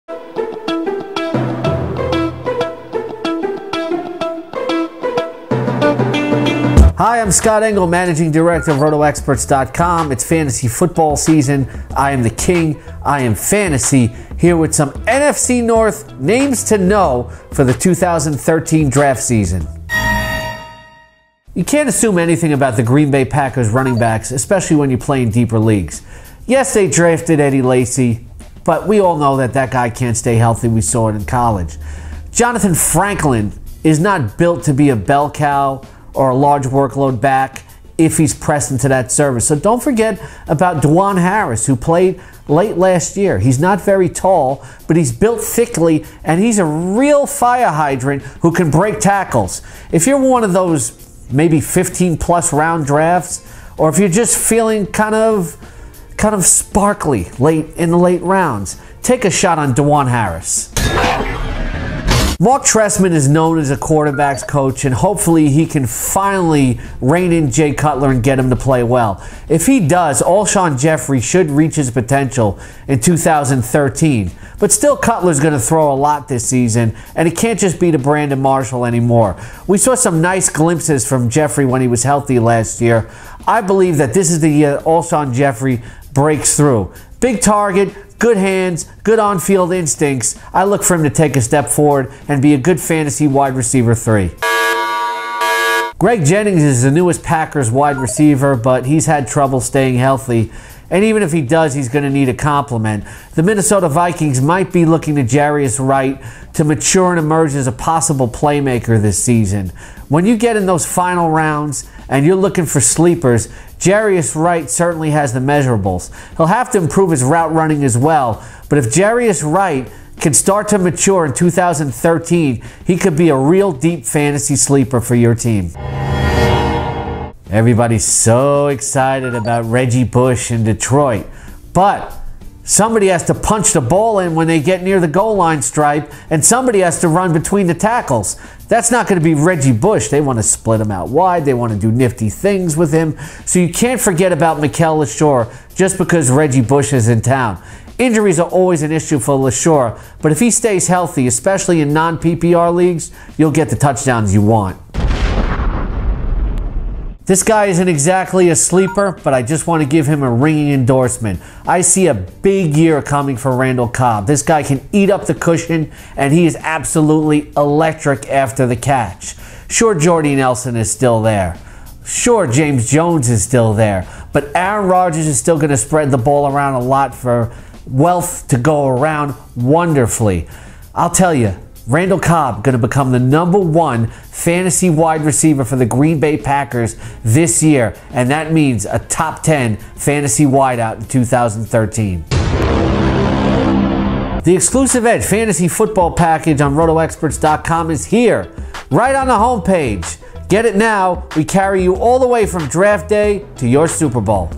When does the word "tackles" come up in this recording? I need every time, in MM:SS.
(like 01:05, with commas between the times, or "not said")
00:48, 02:17.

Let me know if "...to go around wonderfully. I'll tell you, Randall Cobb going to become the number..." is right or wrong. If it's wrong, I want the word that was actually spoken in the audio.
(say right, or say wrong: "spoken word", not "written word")
right.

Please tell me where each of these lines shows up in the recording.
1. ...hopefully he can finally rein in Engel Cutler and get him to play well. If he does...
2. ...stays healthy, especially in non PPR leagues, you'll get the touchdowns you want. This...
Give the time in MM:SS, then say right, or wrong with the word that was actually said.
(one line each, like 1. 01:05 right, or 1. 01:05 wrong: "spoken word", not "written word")
1. 01:04 wrong: "Jay", not "Engel"
2. 02:30 right.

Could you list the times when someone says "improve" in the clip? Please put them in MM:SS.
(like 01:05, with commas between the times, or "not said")
01:56.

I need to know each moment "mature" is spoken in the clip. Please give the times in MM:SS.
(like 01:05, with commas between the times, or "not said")
01:46, 02:00.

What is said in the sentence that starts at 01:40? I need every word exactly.
And even if he does, he's going to need a complement.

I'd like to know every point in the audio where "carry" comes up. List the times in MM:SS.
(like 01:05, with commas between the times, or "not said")
03:21.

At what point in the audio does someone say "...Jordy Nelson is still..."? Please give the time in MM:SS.
02:49.